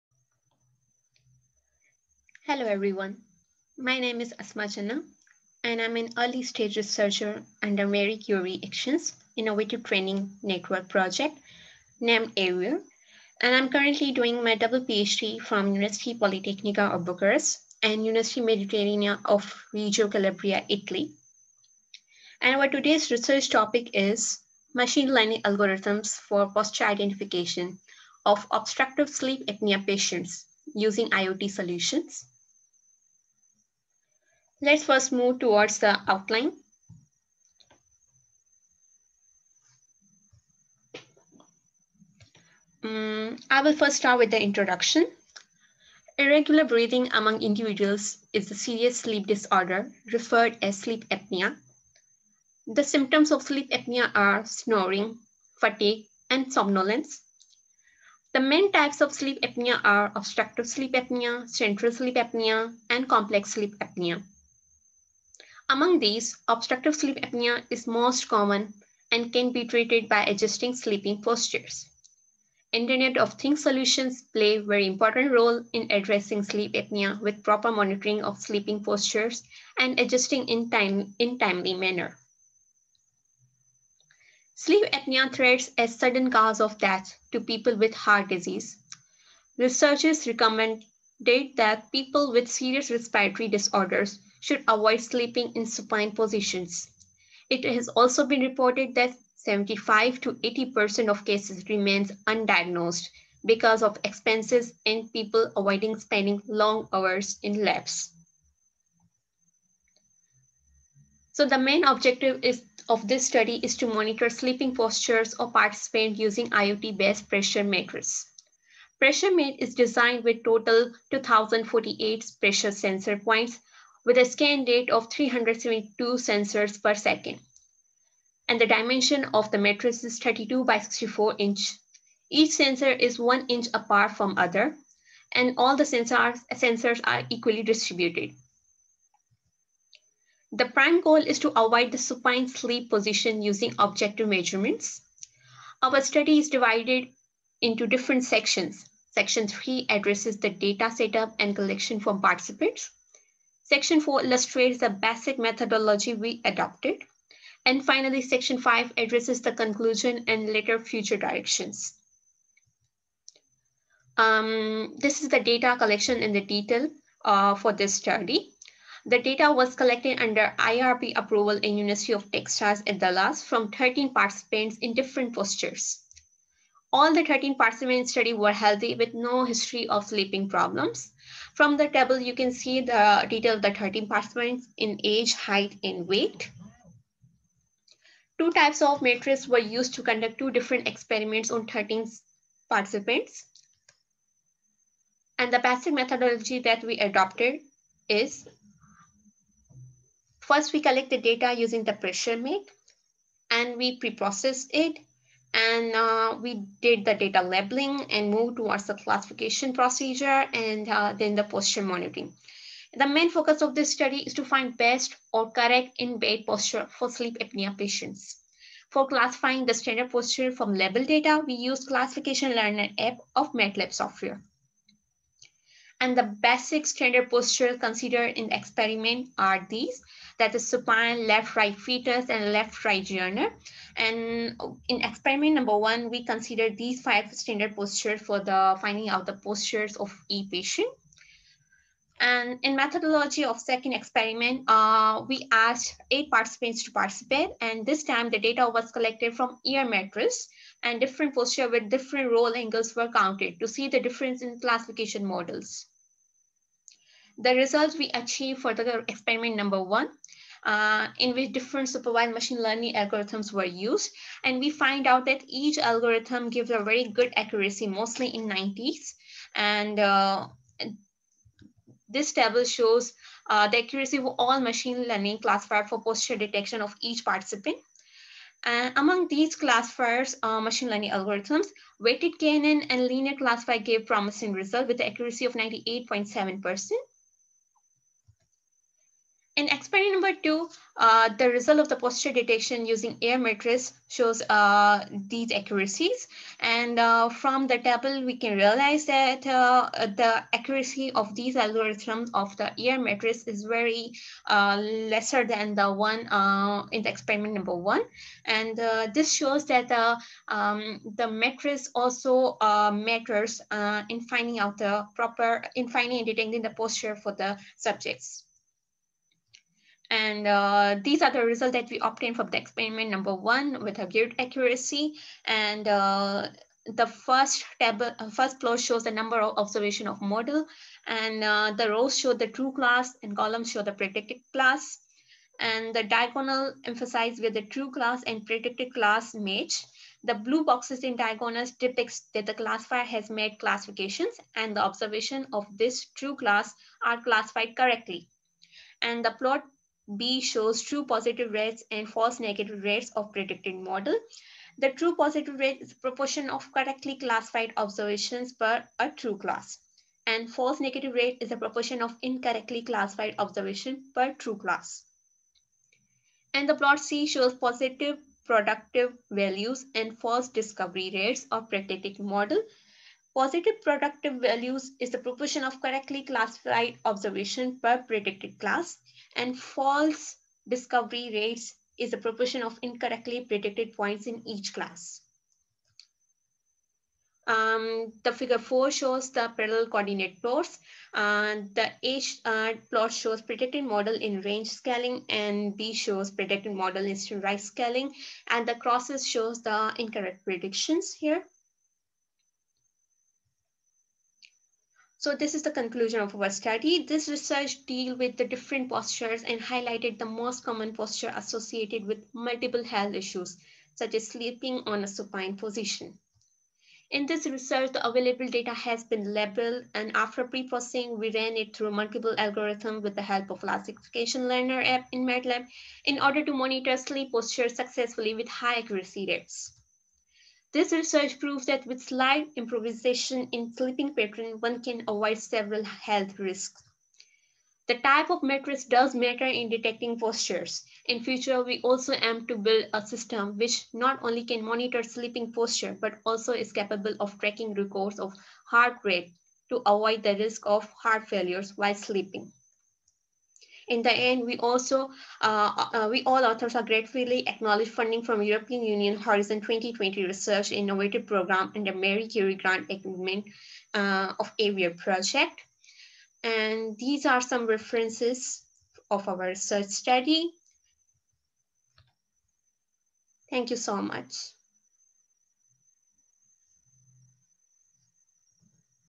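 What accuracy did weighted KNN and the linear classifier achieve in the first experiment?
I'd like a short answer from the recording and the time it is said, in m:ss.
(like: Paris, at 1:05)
98.7%, at 4:45.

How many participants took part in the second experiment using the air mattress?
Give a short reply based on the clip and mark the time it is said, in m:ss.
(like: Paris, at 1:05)
8, at 4:06.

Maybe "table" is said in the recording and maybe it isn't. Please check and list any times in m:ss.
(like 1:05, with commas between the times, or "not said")
3:01, 4:32, 4:57, 5:27.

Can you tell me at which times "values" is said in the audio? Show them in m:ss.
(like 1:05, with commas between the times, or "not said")
6:09, 6:14.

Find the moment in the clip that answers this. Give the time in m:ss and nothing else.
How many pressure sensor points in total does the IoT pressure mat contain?
2:01.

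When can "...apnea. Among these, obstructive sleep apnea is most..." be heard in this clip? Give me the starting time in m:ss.
1:03.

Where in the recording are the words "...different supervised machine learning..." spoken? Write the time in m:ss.
4:21.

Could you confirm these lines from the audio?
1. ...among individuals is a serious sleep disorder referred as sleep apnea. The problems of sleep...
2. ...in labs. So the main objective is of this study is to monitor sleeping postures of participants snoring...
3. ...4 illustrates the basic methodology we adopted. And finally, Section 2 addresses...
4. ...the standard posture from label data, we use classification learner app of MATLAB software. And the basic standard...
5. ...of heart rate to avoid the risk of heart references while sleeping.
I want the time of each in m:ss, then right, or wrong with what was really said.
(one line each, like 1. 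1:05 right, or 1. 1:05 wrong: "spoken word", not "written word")
1. 0:47 wrong: "symptoms", not "problems"
2. 1:47 wrong: "using", not "snoring"
3. 2:34 wrong: "5", not "2"
4. 3:39 right
5. 7:28 wrong: "failures", not "references".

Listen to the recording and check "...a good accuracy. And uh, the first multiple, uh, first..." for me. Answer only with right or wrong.
wrong.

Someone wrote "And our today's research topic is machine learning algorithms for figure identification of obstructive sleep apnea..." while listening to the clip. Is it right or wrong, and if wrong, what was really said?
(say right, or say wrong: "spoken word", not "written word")
wrong: "posture", not "figure".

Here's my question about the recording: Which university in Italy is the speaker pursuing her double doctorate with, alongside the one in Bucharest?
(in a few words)
University Mediterranea of Reggio Calabria.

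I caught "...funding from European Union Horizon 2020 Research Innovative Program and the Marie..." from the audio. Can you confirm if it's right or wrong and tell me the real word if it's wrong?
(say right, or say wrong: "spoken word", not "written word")
right.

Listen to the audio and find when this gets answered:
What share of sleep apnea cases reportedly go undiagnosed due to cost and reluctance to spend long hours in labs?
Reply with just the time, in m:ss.
1:39.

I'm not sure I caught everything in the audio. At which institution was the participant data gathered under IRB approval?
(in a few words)
University of Texas at Dallas.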